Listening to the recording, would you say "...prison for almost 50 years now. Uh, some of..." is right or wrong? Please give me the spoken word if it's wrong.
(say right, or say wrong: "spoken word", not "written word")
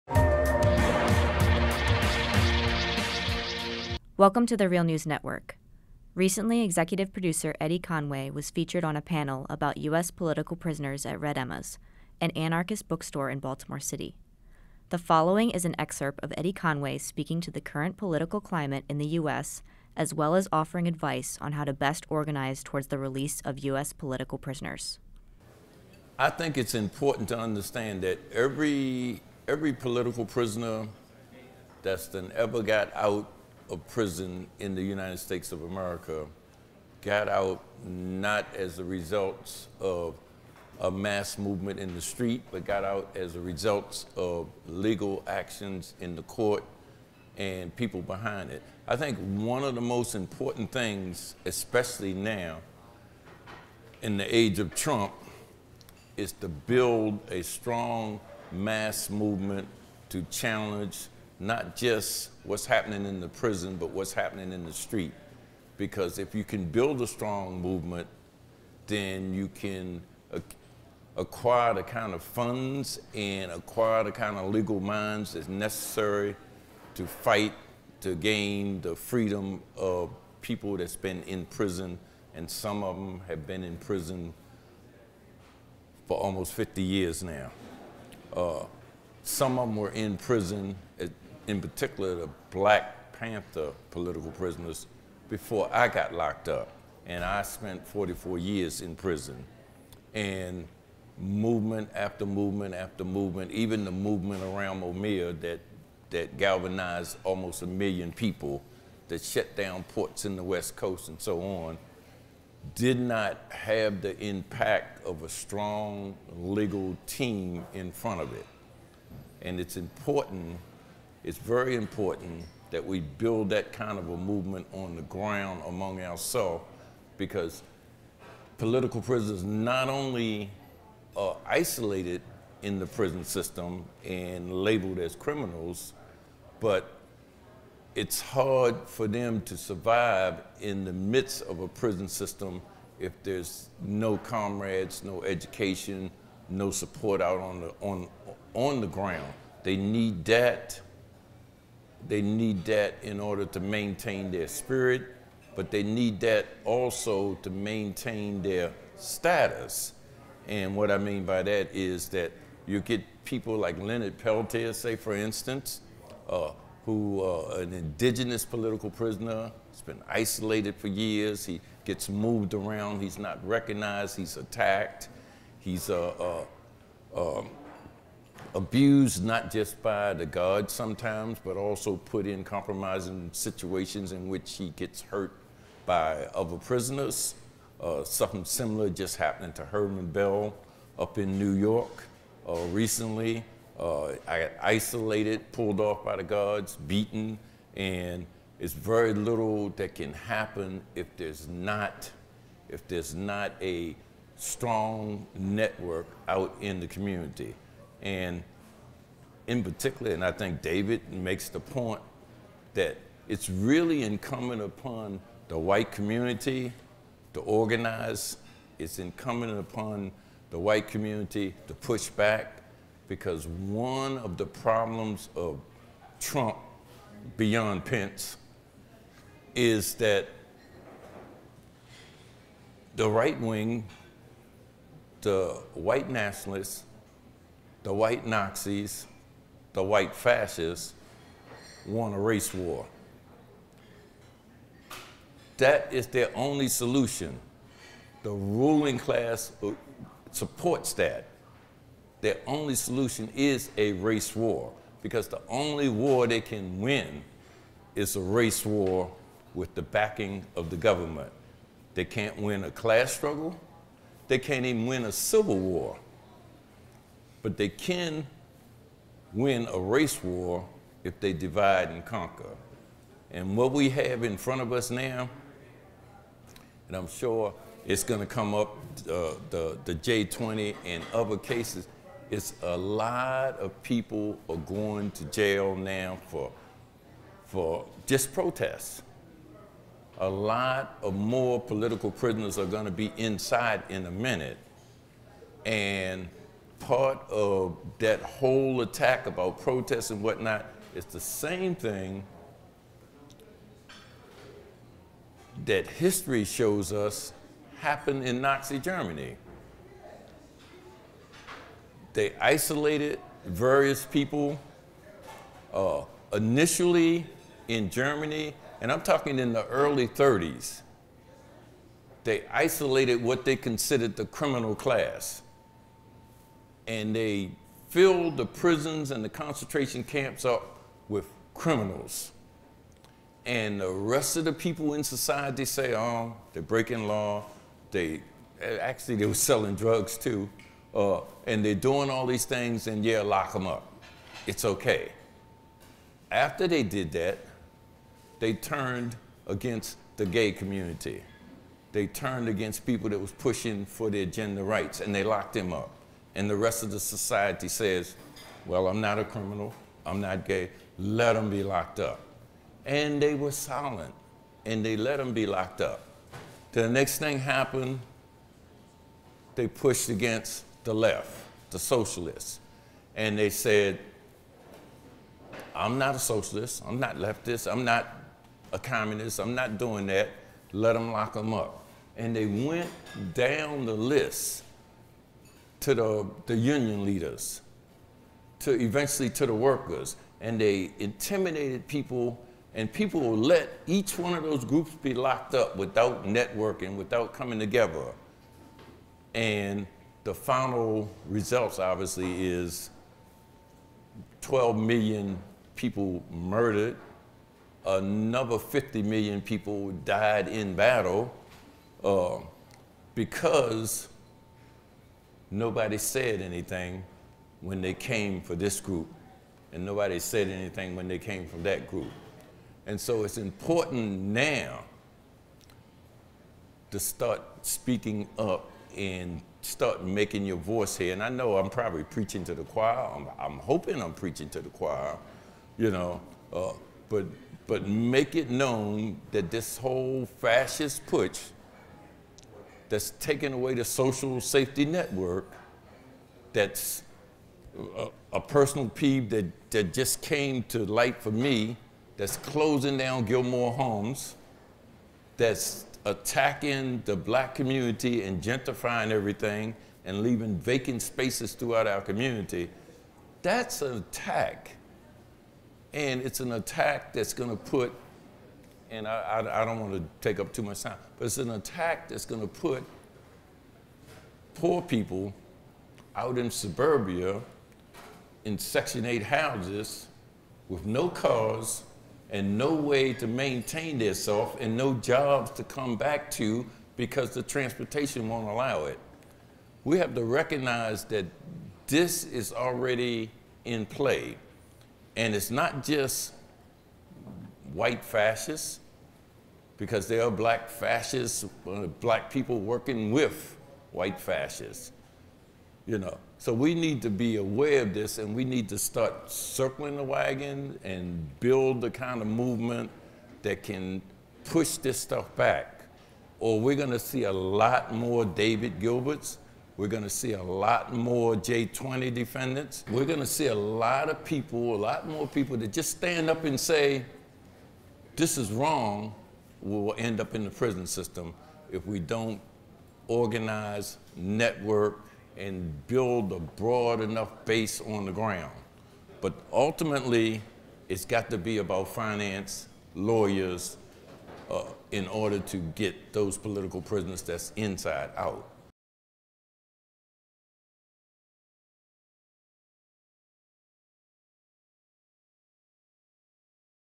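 right.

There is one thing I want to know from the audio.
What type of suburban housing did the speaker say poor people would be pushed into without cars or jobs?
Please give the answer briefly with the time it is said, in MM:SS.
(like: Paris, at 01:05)
Section 8 houses, at 07:58.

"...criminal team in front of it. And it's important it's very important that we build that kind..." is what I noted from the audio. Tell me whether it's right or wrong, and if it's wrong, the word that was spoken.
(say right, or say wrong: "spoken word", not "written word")
wrong: "legal", not "criminal".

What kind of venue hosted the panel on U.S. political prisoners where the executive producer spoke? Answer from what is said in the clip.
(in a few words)
Anarchist bookstore.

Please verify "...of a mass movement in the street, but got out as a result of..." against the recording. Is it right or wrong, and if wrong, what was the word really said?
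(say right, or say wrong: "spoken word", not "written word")
right.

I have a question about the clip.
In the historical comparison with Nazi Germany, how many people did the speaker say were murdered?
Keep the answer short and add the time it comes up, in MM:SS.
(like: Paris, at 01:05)
12 million, at 06:44.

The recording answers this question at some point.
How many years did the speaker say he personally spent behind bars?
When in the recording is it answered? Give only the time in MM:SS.
01:37.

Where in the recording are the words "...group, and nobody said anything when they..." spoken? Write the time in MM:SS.
06:58.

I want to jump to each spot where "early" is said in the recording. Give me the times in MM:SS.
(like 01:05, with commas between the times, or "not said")
05:19.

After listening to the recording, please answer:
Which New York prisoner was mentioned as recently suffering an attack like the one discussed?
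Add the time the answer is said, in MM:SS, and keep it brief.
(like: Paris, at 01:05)
Herman Bell, at 03:09.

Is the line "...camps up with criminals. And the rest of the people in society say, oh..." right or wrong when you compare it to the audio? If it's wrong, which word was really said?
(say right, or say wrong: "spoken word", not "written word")
right.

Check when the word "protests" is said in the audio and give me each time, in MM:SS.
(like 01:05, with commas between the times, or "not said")
04:48, 04:59.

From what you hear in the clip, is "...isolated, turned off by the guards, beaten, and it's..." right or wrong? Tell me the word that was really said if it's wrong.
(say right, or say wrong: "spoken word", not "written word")
wrong: "pulled", not "turned".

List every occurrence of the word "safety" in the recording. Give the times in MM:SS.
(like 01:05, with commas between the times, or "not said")
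07:24.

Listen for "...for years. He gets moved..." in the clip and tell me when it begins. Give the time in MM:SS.
02:50.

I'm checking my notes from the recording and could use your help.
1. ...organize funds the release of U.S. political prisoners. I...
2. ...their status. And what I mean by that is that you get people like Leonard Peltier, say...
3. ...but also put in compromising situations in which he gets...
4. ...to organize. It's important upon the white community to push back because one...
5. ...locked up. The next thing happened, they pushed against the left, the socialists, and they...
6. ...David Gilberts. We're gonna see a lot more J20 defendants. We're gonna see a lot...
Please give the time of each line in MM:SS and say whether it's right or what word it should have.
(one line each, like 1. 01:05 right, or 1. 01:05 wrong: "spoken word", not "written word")
1. 00:22 wrong: "towards", not "funds"
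2. 02:38 right
3. 03:01 right
4. 03:37 wrong: "incumbent", not "important"
5. 06:05 right
6. 08:38 right.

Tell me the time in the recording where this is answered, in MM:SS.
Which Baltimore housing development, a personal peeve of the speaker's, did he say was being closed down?
07:33.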